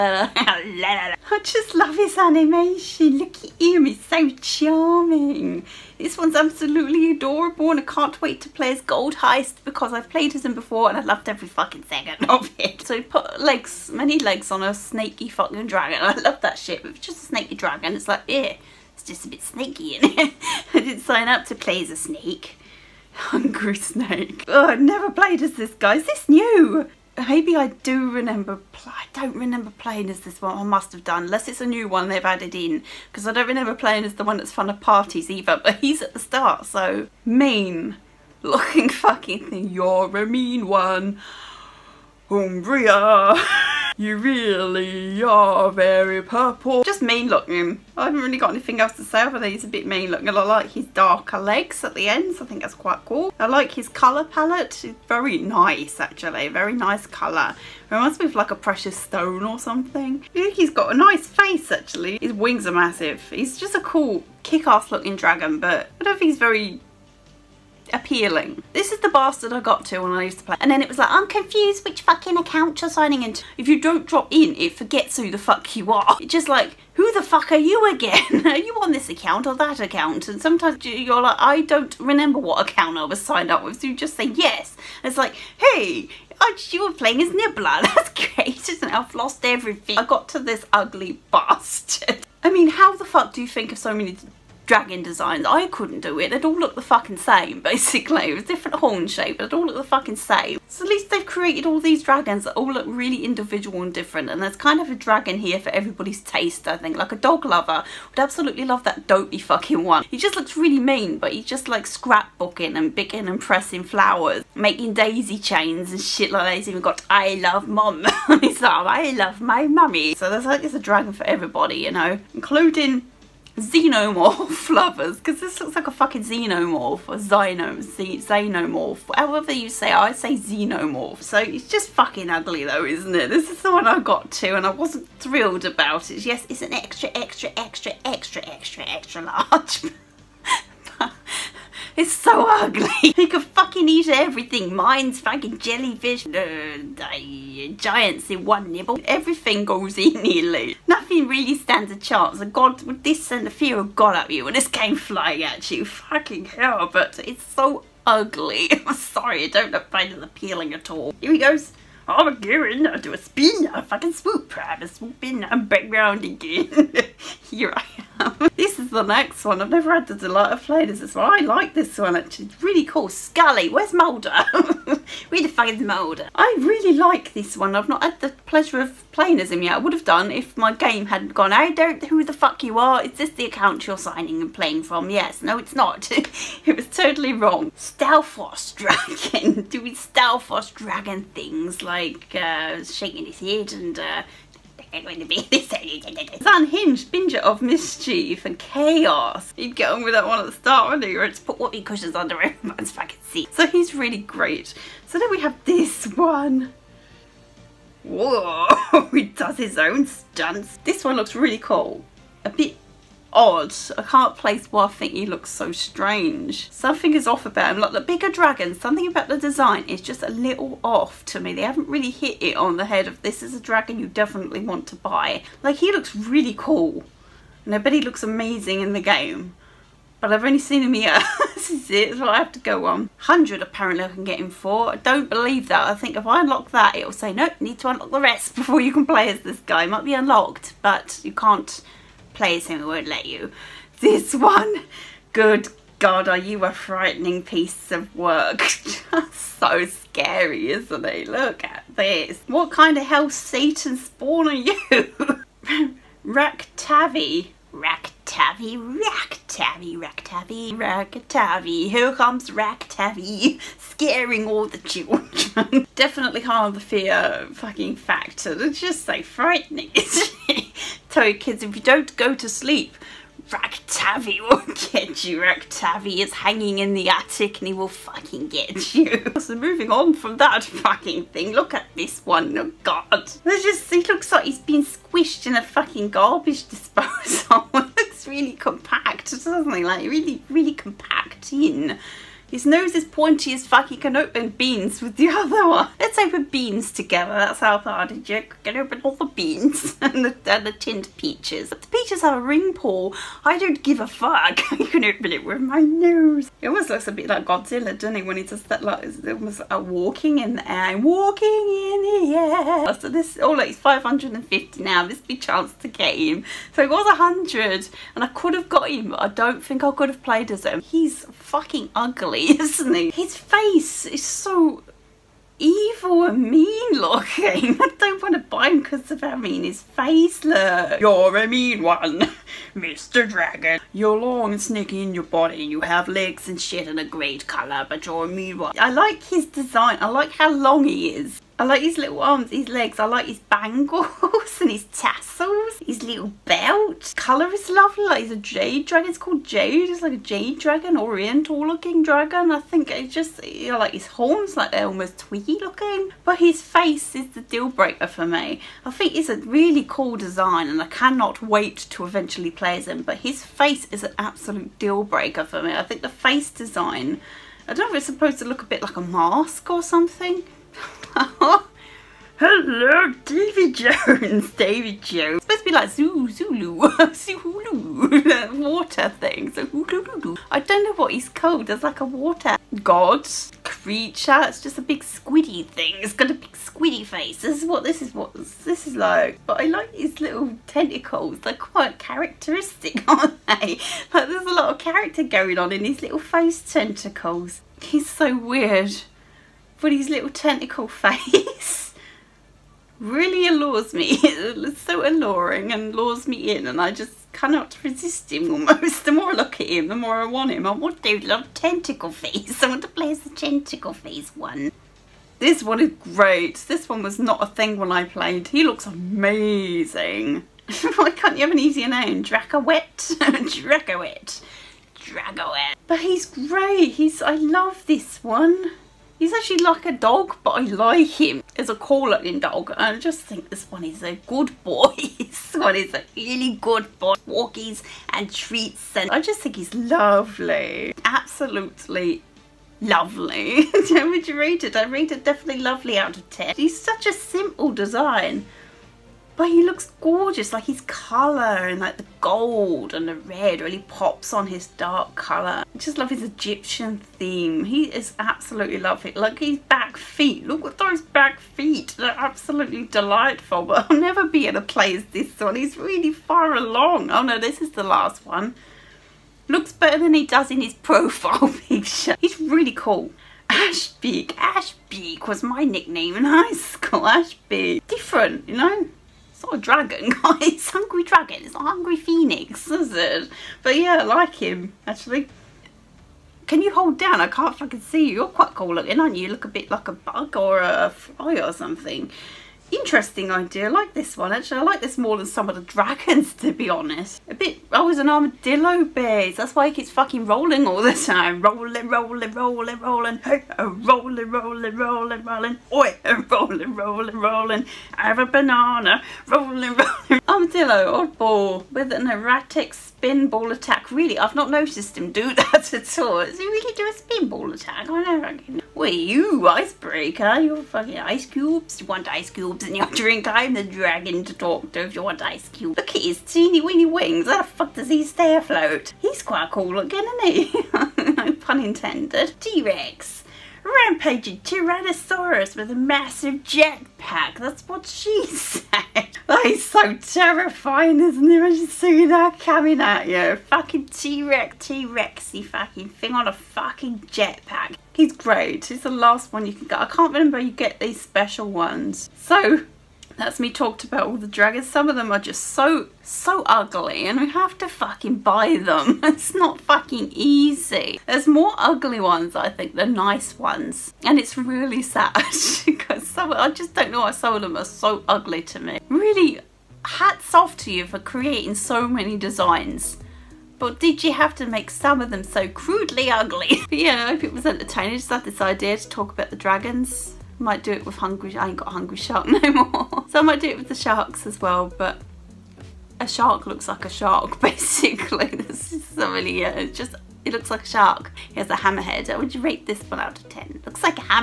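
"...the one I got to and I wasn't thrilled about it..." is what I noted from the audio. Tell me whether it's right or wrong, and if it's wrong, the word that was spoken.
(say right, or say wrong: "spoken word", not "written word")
right.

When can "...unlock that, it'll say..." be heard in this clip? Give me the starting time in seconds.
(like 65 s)
236 s.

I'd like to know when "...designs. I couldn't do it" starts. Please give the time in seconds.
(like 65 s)
95 s.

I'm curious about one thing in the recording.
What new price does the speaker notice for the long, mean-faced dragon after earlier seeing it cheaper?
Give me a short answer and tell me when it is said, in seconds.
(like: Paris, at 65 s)
550, at 313 s.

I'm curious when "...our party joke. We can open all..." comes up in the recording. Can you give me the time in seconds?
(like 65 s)
297 s.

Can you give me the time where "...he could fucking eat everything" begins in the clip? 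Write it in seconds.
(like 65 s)
143 s.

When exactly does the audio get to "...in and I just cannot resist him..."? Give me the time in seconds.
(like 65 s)
406 s.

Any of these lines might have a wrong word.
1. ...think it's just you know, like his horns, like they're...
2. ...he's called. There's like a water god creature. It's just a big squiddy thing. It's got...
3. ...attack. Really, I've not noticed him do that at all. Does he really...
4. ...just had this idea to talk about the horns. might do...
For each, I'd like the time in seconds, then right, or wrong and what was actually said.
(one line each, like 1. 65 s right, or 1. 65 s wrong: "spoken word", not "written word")
1. 352 s right
2. 381 s right
3. 513 s right
4. 577 s wrong: "dragons", not "horns".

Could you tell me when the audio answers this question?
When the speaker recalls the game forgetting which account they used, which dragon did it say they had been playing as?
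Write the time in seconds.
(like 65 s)
87 s.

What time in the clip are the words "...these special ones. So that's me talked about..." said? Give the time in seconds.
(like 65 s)
550 s.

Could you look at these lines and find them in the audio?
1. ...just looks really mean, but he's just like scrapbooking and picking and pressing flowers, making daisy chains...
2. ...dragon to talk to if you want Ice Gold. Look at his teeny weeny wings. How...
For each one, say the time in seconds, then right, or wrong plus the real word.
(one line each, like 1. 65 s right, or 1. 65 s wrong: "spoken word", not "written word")
1. 110 s right
2. 523 s wrong: "Cube", not "Gold".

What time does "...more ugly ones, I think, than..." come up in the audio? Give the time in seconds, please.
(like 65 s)
561 s.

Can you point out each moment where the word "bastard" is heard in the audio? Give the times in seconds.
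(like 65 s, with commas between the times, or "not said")
69 s, 91 s.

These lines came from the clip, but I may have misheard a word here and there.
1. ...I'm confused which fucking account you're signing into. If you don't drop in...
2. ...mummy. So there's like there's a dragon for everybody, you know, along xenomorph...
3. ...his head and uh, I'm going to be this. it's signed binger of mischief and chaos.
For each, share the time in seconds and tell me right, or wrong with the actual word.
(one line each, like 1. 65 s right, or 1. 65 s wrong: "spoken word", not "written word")
1. 71 s right
2. 119 s wrong: "including", not "along"
3. 193 s wrong: "unhinged", not "signed".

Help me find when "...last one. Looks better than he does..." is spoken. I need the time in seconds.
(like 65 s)
467 s.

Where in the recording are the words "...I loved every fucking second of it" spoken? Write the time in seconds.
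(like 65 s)
10 s.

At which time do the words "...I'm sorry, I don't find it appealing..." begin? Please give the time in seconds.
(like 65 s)
158 s.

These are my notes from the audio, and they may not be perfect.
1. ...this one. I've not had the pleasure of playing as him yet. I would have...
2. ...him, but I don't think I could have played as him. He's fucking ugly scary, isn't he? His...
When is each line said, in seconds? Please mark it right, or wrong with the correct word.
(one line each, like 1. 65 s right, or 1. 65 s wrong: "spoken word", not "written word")
1. 177 s right
2. 318 s right.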